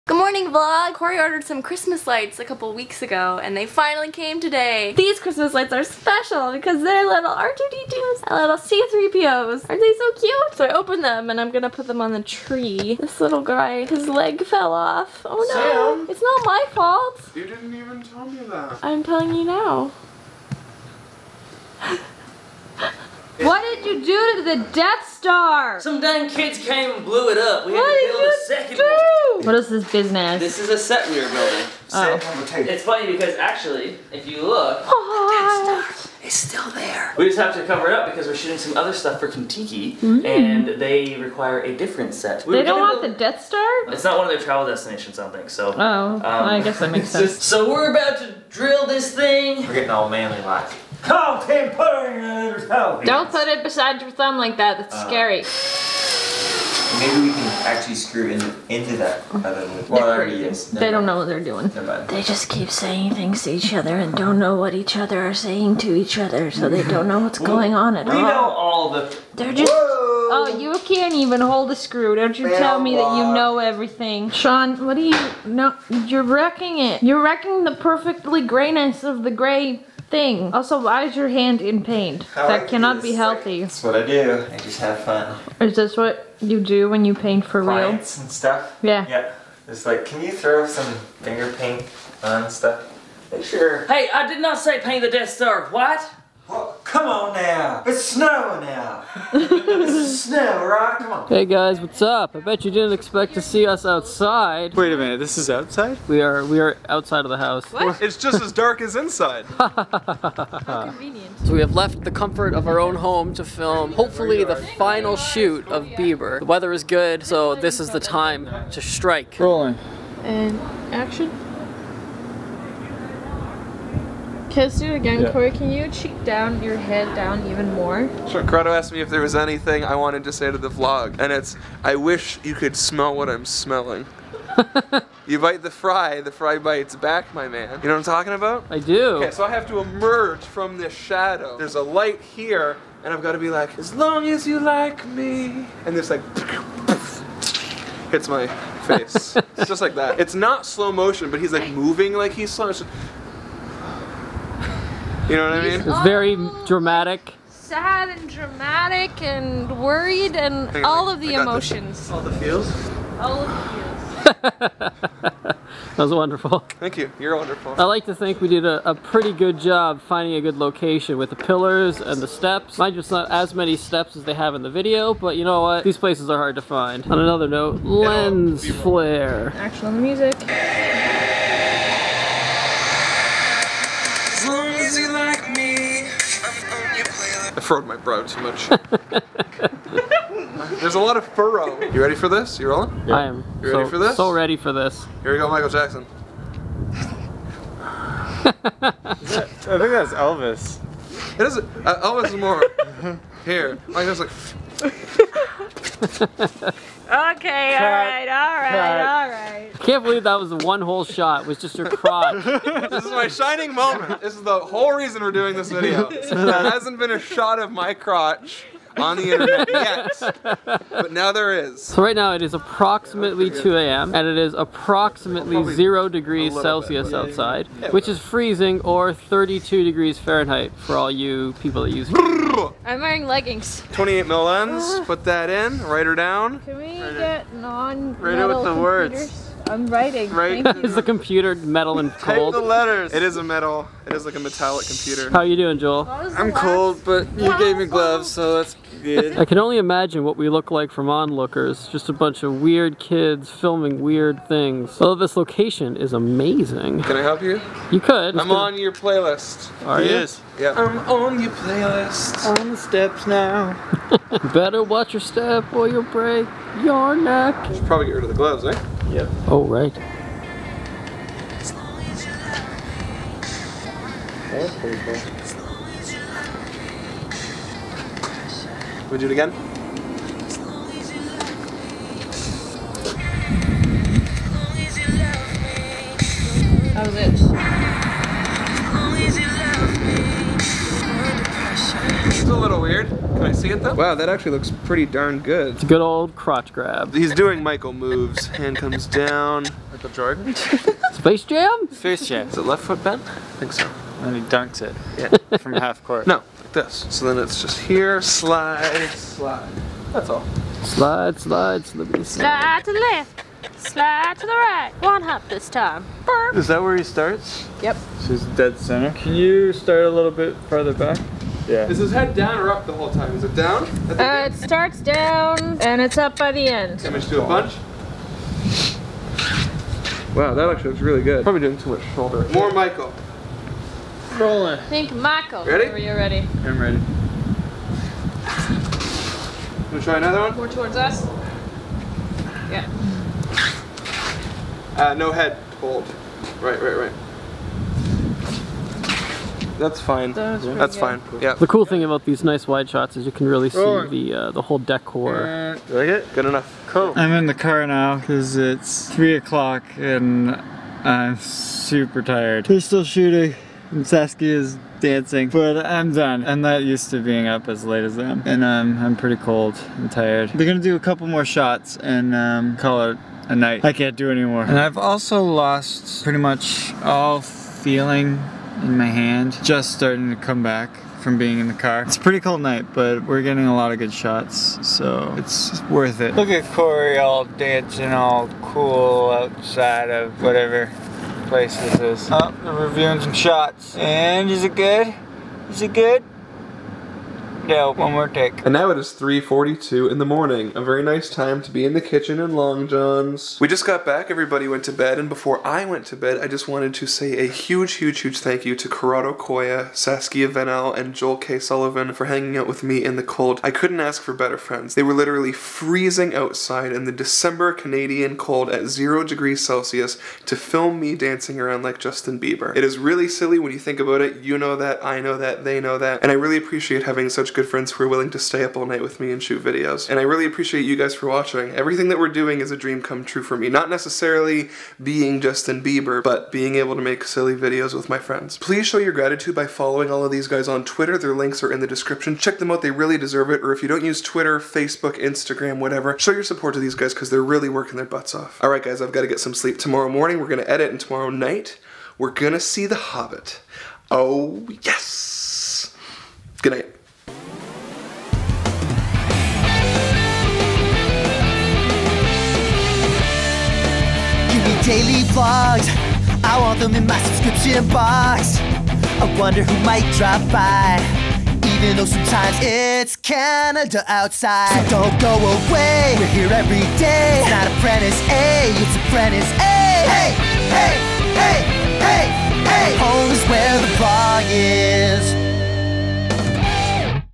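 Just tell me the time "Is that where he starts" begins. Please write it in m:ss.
5:16.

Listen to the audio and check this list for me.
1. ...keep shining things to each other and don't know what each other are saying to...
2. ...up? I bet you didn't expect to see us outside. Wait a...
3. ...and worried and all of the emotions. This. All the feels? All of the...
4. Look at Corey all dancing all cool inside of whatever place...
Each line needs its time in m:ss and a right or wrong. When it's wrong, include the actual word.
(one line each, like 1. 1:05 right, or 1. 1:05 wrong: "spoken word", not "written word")
1. 1:02 wrong: "saying", not "shining"
2. 1:42 right
3. 2:39 right
4. 6:26 wrong: "outside", not "inside".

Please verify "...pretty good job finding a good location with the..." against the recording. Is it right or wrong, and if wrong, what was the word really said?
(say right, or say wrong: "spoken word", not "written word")
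right.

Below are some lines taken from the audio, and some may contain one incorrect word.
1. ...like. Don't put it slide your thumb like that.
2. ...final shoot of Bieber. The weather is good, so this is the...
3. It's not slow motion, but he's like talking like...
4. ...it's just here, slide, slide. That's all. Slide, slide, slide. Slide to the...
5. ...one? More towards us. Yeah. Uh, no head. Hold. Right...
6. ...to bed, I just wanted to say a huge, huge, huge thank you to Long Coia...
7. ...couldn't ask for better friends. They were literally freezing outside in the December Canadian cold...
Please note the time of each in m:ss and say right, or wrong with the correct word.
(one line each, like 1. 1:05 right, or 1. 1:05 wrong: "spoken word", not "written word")
1. 0:50 wrong: "beside", not "slide"
2. 1:54 right
3. 2:30 wrong: "moving", not "talking"
4. 5:07 right
5. 5:40 right
6. 6:46 wrong: "Corrado", not "Long"
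7. 6:53 right.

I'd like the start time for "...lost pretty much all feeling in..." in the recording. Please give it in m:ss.
6:15.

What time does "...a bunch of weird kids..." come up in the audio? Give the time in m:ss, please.
4:12.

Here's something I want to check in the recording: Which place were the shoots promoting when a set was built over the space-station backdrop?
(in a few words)
Kentucky.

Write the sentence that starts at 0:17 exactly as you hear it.
You didn't even tell me that.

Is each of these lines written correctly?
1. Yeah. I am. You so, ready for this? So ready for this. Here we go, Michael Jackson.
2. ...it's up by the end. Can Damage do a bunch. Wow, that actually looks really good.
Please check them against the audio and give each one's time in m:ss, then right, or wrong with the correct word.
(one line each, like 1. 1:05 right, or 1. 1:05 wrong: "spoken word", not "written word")
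1. 3:13 right
2. 5:26 right.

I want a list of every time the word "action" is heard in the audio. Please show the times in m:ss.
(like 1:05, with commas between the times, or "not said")
2:00, 2:59.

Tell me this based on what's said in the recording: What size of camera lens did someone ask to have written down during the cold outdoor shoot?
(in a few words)
28 mil.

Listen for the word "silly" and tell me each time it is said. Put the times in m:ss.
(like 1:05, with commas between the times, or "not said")
7:03, 7:17.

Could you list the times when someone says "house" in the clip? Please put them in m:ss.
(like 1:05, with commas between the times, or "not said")
1:47.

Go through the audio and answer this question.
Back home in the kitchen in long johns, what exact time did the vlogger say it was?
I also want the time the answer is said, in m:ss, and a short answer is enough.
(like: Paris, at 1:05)
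3:42, at 6:39.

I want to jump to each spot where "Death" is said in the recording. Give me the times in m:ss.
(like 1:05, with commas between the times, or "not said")
0:24, 0:35, 0:43, 1:35.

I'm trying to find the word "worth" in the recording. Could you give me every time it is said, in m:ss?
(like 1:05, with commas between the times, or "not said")
6:25.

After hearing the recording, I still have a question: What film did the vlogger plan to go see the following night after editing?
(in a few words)
The Hobbit.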